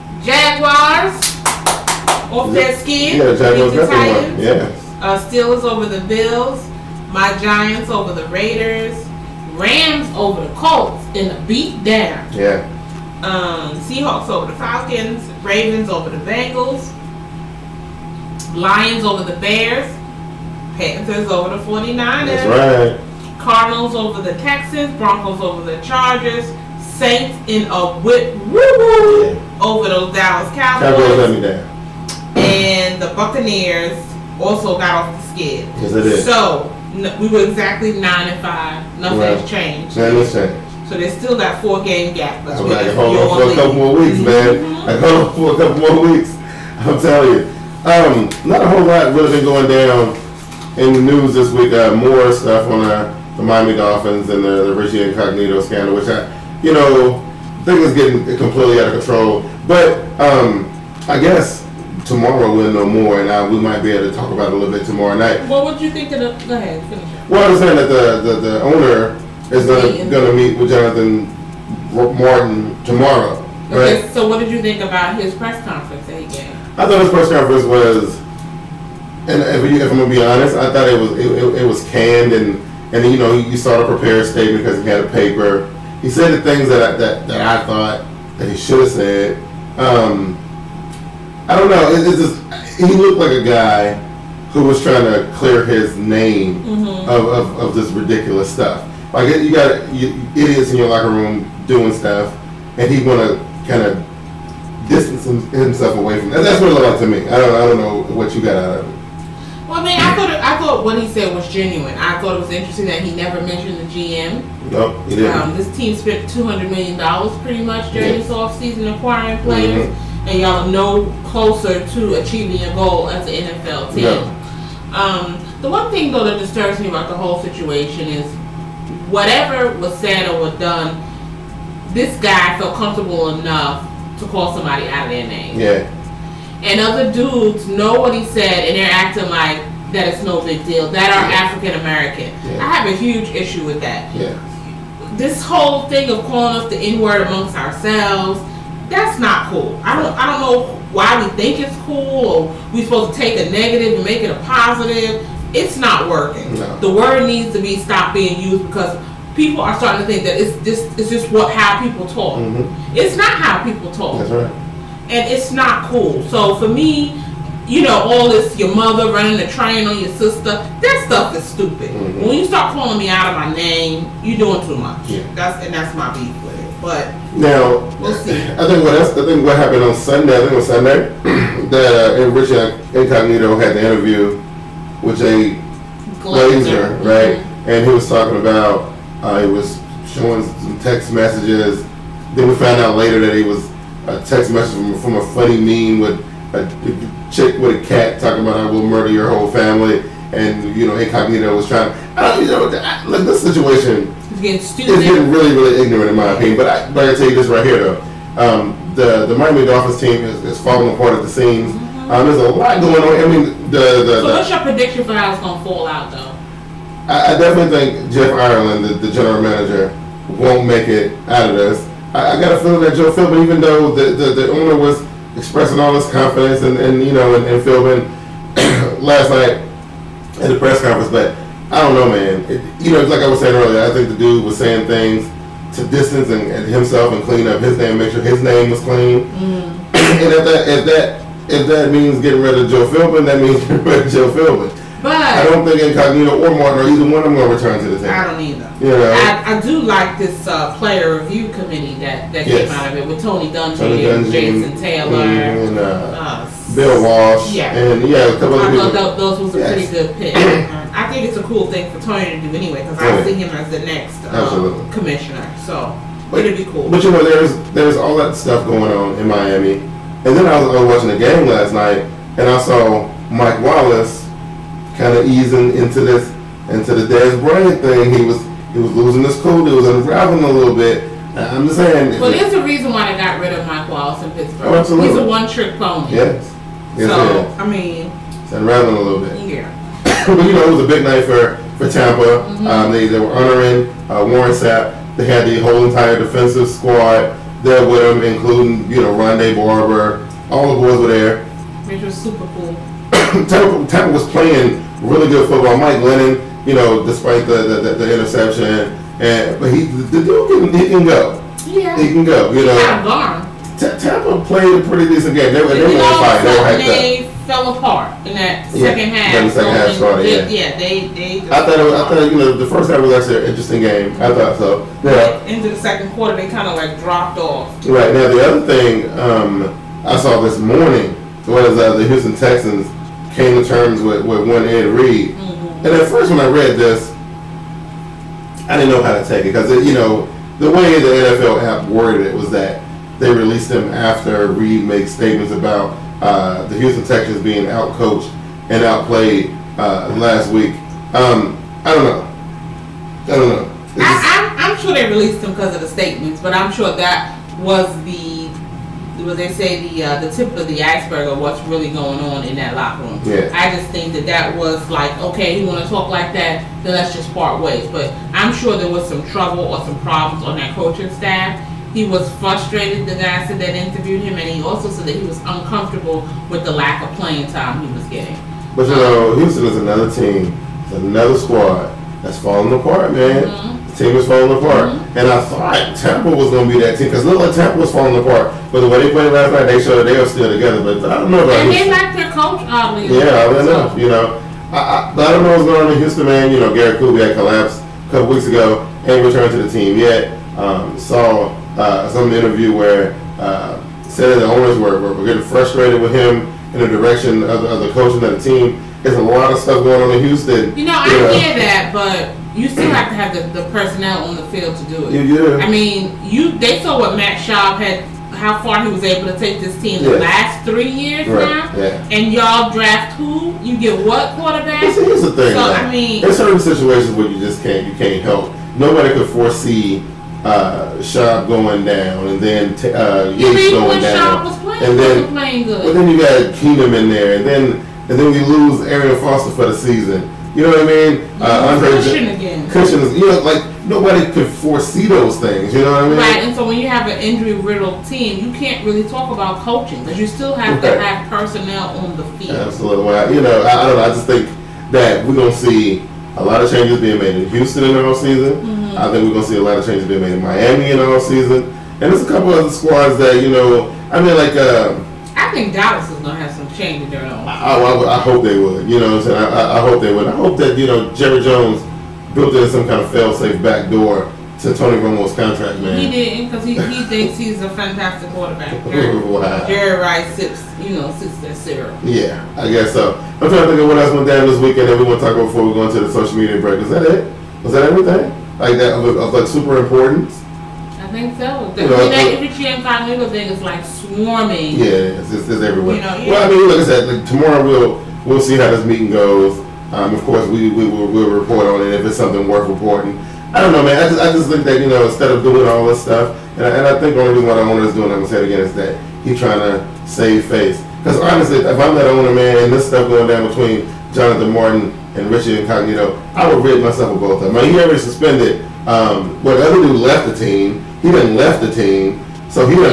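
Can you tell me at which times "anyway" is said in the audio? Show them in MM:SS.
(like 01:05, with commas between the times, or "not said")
04:22.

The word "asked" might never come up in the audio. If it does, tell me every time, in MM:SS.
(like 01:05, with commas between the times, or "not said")
not said.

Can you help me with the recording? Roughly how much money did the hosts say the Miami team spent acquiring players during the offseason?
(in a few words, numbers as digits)
200 million dollars.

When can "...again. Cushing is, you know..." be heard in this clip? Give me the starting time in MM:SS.
07:22.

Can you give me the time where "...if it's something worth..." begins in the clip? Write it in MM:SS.
08:21.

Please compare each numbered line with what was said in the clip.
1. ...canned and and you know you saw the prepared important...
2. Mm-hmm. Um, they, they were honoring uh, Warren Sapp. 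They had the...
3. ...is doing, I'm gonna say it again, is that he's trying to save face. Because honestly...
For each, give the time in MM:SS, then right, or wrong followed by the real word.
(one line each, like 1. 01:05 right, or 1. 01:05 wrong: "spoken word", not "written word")
1. 01:21 wrong: "statement", not "important"
2. 04:52 right
3. 08:27 right.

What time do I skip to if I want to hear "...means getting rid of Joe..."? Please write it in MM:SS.
04:01.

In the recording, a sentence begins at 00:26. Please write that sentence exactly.
Saints in a whip woo woo yeah.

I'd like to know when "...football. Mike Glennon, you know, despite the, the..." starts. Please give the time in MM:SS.
05:05.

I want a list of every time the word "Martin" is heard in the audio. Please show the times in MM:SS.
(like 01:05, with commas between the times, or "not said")
01:11, 04:06, 08:34.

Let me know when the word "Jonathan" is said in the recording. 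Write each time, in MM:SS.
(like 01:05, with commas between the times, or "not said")
01:10, 08:34.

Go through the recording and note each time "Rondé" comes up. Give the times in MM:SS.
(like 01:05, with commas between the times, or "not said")
04:59.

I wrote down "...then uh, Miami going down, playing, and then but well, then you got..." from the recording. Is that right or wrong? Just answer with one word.
wrong.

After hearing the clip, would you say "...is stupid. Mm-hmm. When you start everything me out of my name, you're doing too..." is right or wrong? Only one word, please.
wrong.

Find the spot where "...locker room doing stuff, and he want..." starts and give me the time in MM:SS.
01:40.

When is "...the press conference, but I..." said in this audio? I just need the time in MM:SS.
03:50.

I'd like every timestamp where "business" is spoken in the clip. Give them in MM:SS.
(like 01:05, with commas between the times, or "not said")
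not said.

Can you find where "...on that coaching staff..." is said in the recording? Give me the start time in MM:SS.
06:10.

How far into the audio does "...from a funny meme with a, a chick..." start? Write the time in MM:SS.
03:15.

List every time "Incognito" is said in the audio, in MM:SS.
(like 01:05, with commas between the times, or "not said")
00:55, 03:02, 03:20, 04:05, 08:35.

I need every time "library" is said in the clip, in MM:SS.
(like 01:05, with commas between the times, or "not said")
not said.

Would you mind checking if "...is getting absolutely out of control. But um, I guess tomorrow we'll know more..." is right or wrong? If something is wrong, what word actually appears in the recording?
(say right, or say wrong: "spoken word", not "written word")
wrong: "completely", not "absolutely".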